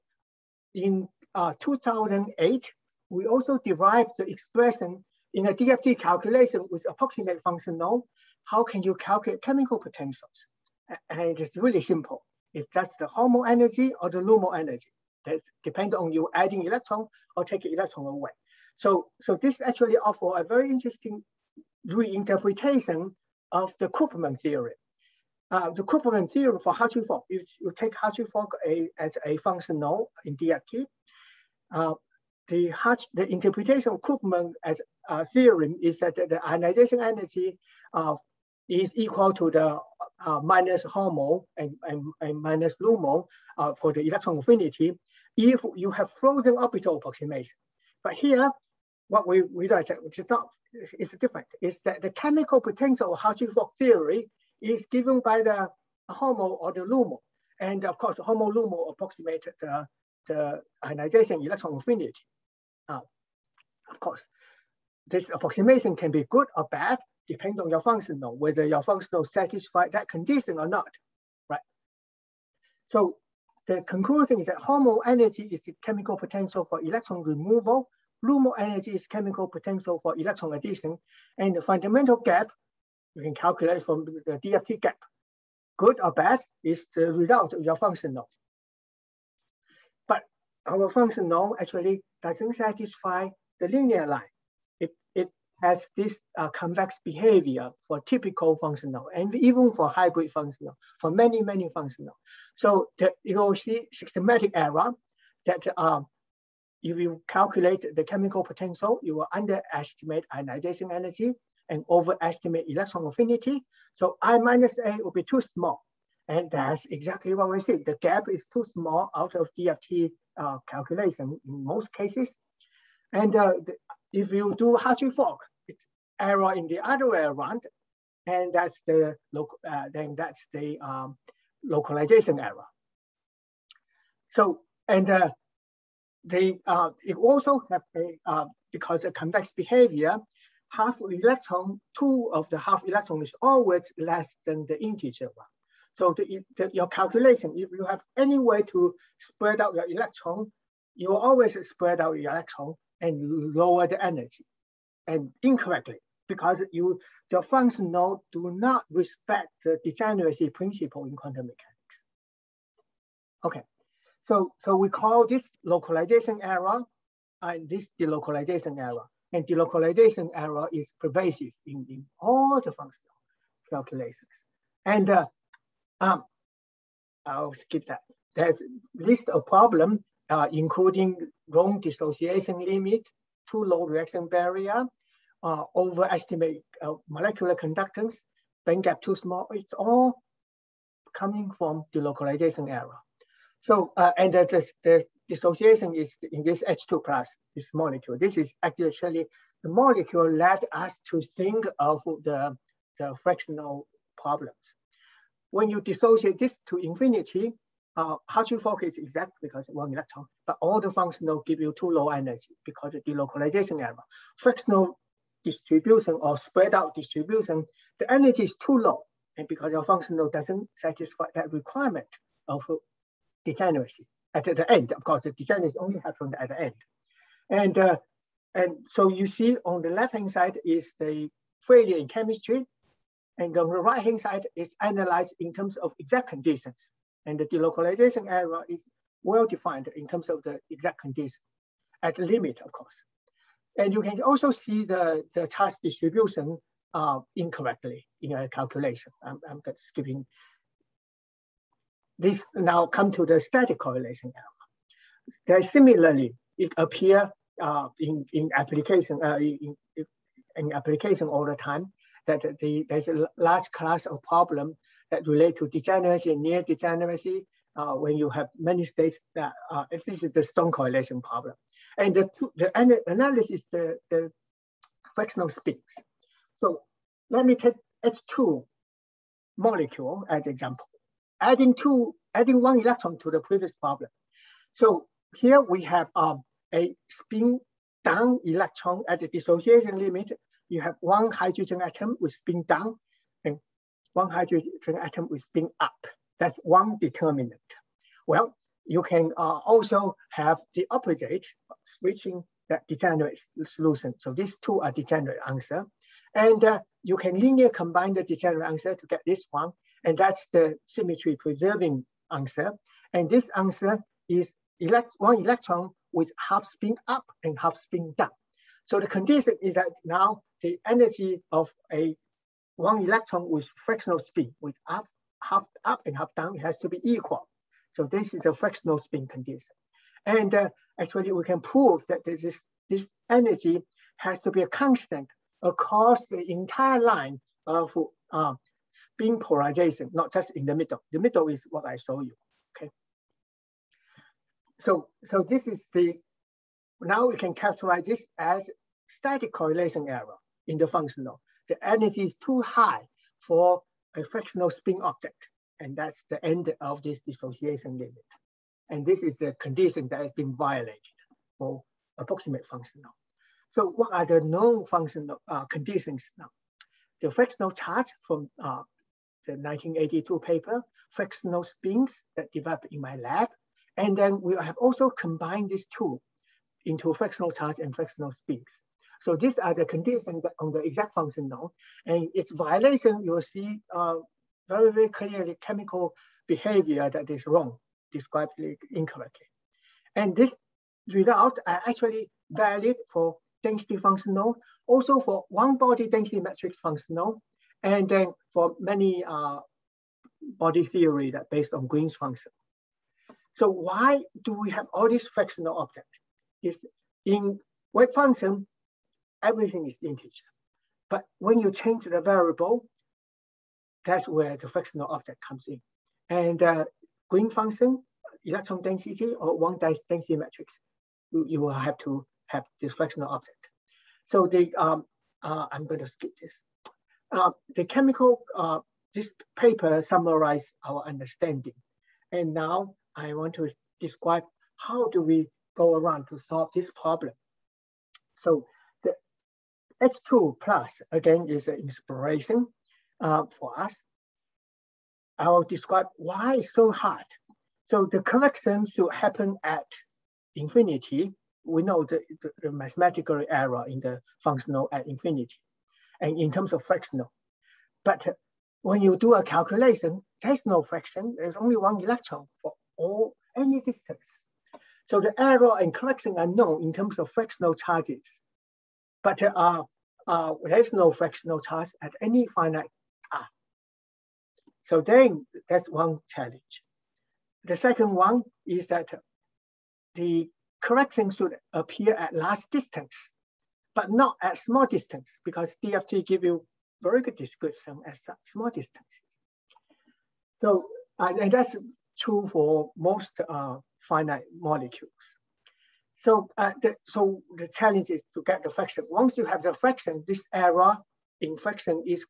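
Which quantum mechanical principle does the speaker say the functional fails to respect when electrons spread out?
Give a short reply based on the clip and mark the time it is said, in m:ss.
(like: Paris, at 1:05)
Degeneracy principle, at 2:39.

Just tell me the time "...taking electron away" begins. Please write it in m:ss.
0:17.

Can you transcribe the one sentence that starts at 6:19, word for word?
So these are the conditions on the exact function now.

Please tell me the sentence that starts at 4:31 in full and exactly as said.
And the, two, the analysis, the, the fractional spins.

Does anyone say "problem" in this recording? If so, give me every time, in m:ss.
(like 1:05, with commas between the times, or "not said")
2:59, 3:24, 4:24, 4:31, 4:43, 7:16.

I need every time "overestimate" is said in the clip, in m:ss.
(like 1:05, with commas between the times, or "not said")
1:51, 3:05.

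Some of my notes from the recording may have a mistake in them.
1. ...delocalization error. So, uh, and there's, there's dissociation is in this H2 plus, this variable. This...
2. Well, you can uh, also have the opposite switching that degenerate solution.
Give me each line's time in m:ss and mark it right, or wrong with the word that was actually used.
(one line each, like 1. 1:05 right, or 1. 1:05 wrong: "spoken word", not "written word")
1. 3:11 wrong: "molecule", not "variable"
2. 4:58 right.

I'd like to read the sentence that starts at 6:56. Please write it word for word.
And uh, Green function, electron density, or one density matrix, you, you will have to have dysfunctional object.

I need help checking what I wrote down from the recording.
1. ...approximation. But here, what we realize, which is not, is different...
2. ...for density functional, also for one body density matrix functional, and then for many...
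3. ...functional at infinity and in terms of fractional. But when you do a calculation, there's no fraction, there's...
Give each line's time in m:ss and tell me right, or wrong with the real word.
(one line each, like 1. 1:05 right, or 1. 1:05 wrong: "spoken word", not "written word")
1. 0:46 right
2. 6:33 right
3. 7:34 right.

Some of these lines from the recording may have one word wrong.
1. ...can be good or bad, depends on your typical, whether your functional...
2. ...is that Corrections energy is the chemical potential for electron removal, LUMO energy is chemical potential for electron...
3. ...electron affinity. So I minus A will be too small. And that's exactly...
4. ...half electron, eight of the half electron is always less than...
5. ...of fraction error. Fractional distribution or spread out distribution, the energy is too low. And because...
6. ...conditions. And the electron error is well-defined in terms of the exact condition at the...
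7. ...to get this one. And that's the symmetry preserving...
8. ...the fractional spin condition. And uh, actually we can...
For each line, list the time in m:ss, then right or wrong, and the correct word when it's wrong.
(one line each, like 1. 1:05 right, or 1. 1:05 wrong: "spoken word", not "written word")
1. 1:05 wrong: "functional", not "typical"
2. 1:14 wrong: "HOMO", not "Corrections"
3. 1:52 right
4. 2:20 wrong: "two", not "eight"
5. 3:32 wrong: "delocalization", not "fraction"
6. 3:56 wrong: "delocalization", not "electron"
7. 5:08 right
8. 5:28 right.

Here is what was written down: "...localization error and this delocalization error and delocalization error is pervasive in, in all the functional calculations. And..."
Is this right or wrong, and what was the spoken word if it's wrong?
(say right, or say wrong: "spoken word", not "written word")
right.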